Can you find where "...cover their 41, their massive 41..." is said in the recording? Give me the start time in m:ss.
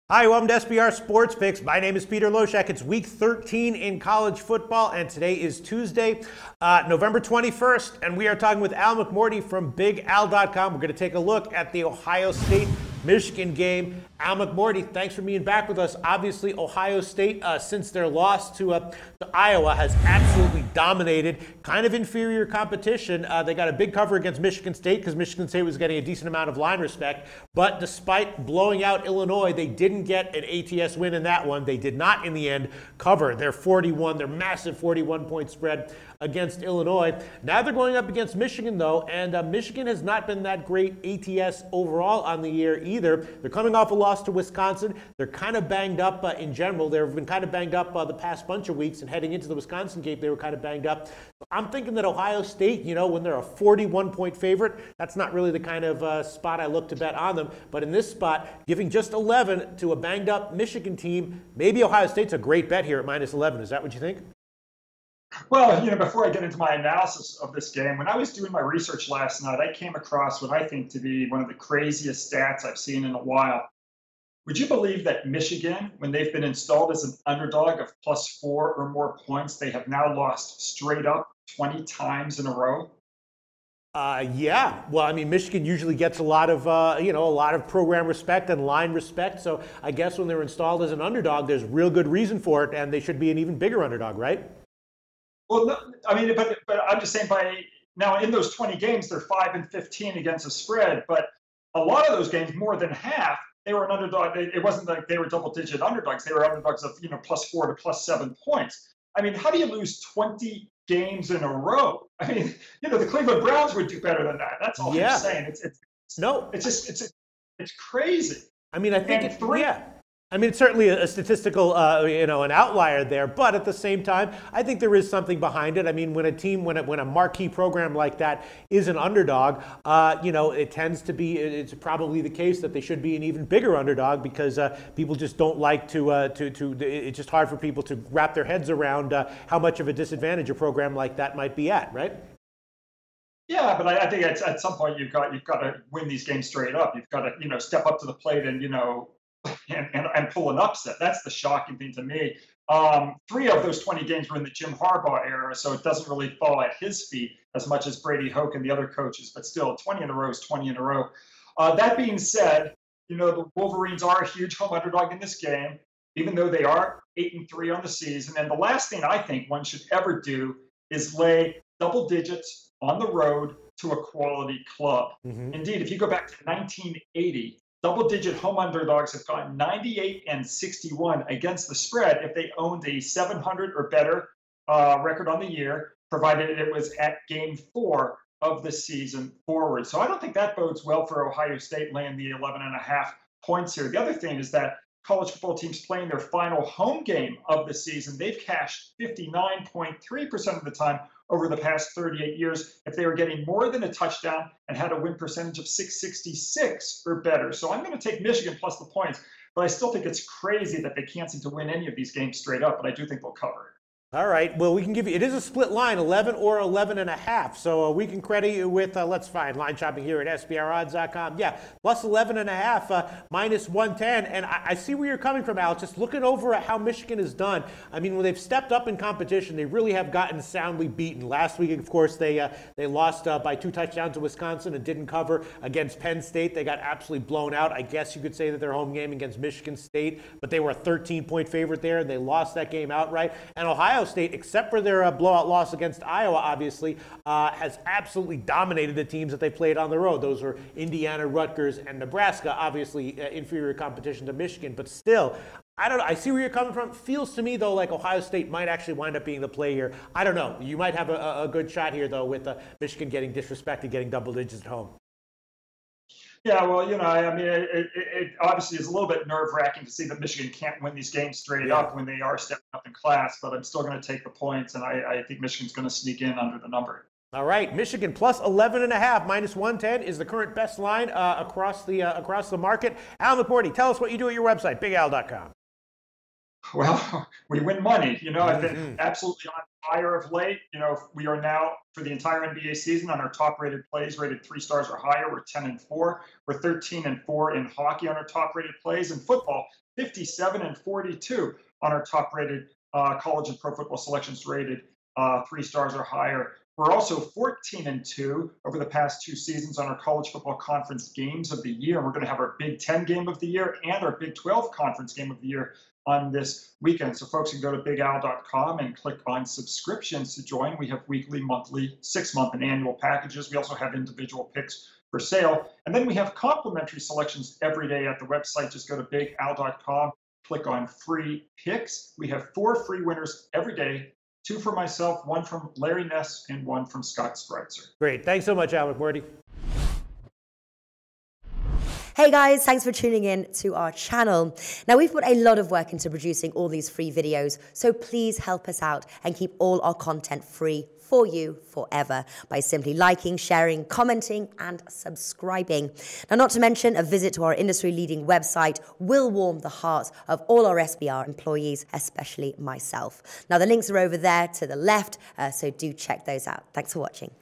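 0:32.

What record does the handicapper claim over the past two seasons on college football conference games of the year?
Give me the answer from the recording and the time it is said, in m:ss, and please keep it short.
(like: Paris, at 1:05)
14-2, at 5:07.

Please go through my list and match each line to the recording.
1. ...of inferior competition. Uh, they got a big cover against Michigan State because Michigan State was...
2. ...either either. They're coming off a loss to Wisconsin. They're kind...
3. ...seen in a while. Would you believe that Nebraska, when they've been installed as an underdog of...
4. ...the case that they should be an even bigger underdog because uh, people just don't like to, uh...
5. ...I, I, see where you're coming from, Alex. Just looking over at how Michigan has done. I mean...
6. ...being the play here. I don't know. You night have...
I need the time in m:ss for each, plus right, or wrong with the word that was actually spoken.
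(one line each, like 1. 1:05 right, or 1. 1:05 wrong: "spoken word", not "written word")
1. 0:21 right
2. 0:42 right
3. 1:12 wrong: "Michigan", not "Nebraska"
4. 2:12 right
5. 3:44 right
6. 4:19 wrong: "might", not "night".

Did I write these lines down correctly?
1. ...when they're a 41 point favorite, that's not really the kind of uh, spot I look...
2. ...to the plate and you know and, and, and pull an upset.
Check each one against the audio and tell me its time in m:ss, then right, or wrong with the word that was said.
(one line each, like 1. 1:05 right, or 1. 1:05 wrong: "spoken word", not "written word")
1. 0:53 right
2. 2:27 right.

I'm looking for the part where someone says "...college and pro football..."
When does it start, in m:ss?
5:03.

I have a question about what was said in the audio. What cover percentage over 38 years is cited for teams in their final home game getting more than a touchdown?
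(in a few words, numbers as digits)
59.3%.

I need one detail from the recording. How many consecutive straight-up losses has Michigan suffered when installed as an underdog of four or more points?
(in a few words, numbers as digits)
20.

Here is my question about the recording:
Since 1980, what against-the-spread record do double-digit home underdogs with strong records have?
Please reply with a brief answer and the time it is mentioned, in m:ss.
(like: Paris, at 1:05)
98-61, at 2:59.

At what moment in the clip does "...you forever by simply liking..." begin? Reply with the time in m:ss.
5:51.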